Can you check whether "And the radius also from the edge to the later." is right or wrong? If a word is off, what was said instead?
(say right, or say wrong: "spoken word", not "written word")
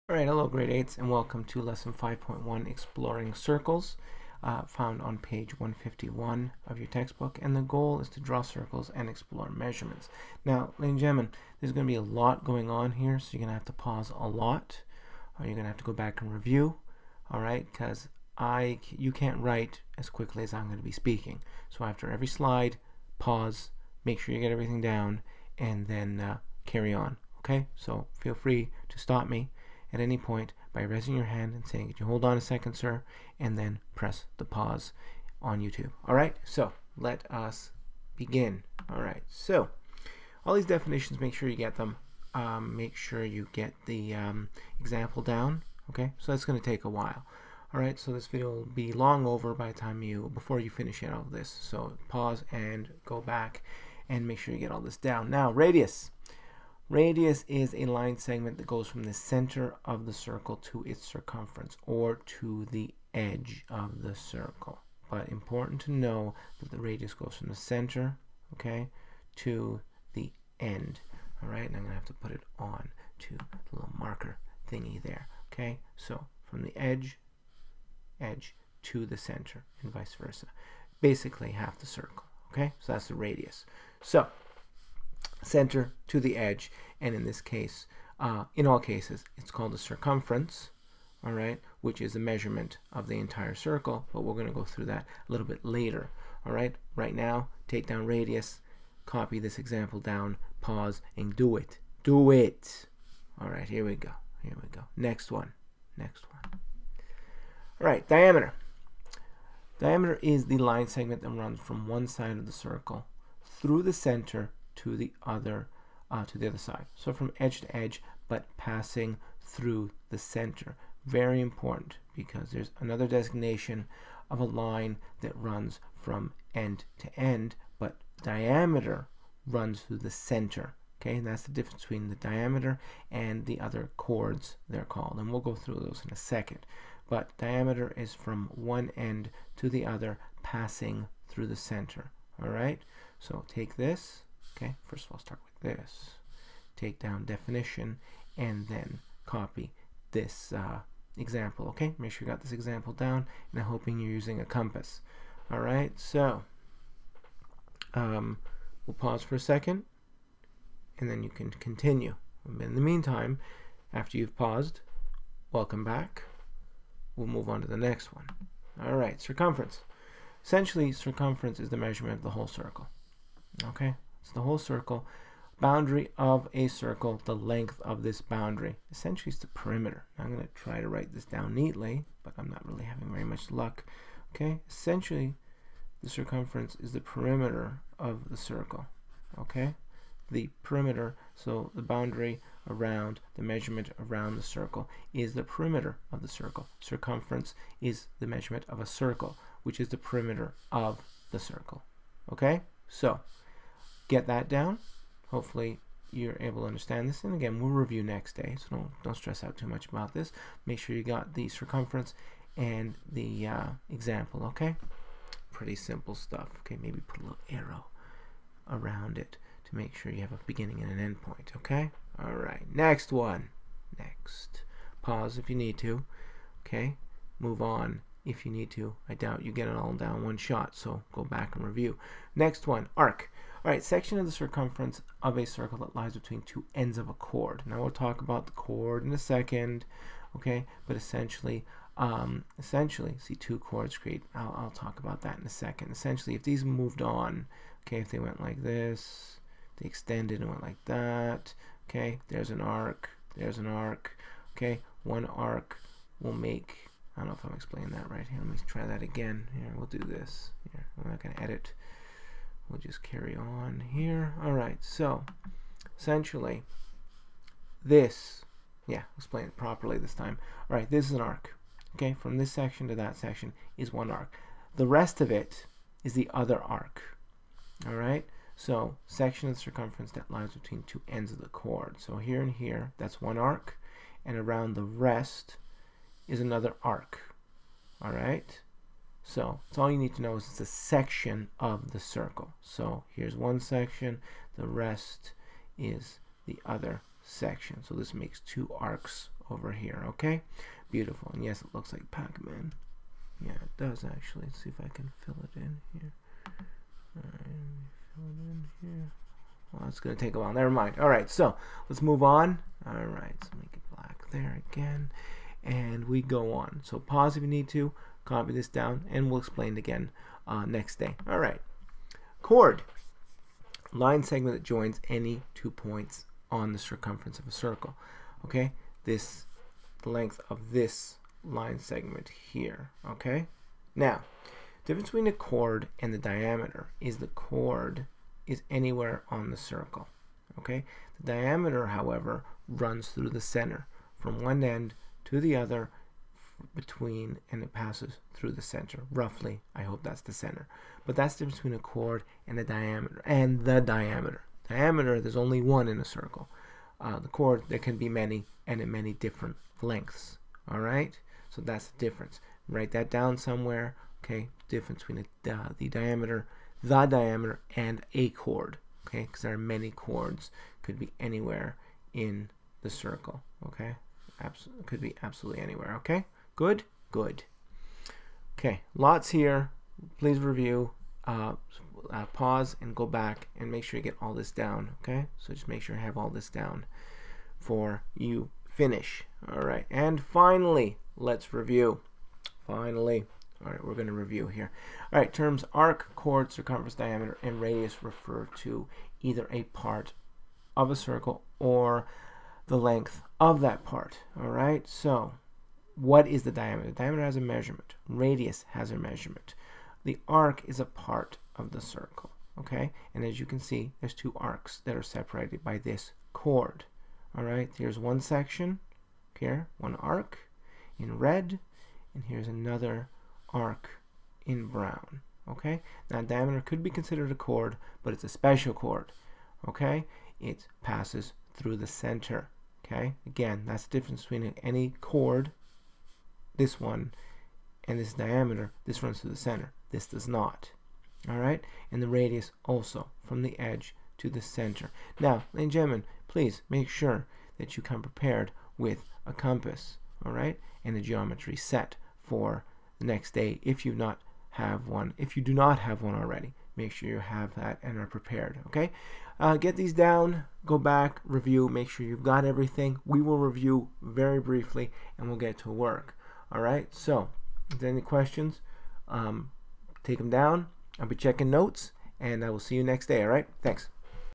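wrong: "center", not "later".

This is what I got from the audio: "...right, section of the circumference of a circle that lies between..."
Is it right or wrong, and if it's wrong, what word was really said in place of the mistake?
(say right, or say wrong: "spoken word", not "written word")
right.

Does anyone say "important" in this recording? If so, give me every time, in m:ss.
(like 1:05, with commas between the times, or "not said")
1:05, 2:01.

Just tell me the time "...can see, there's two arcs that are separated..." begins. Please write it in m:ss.
6:53.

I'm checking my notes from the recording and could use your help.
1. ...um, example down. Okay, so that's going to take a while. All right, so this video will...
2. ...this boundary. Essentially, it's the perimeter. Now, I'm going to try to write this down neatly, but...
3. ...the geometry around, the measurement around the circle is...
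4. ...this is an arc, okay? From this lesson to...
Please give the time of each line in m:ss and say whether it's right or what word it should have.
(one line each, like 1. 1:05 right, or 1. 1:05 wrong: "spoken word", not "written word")
1. 0:44 right
2. 2:58 right
3. 3:11 wrong: "boundary", not "geometry"
4. 4:30 wrong: "section", not "lesson".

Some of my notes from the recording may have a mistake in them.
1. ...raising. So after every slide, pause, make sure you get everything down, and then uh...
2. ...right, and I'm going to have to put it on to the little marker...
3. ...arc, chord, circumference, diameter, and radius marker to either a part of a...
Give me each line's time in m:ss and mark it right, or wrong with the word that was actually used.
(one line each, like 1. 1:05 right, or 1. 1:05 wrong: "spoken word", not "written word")
1. 0:20 wrong: "speaking", not "raising"
2. 1:11 right
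3. 6:35 wrong: "refer", not "marker".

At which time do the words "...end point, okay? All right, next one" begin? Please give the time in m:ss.
3:40.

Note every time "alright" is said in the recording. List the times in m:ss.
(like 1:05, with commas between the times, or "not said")
0:00, 0:17, 6:00.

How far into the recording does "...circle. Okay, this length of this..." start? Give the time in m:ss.
5:27.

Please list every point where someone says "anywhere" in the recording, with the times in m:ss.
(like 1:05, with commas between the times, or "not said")
5:38, 6:11, 6:15.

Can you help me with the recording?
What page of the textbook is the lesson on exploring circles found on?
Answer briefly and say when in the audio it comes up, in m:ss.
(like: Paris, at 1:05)
151, at 0:05.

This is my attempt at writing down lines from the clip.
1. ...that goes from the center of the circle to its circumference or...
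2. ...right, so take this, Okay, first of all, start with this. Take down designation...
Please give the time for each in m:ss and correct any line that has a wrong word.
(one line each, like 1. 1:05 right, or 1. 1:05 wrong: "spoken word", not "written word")
1. 0:58 right
2. 2:22 wrong: "definition", not "designation".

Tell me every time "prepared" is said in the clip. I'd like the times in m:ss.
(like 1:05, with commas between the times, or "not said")
7:28, 7:38.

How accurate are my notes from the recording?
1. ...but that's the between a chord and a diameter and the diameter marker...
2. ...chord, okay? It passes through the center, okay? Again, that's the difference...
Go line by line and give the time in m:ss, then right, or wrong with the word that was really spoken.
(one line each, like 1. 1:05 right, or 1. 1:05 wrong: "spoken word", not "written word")
1. 5:51 wrong: "diameter", not "marker"
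2. 7:08 right.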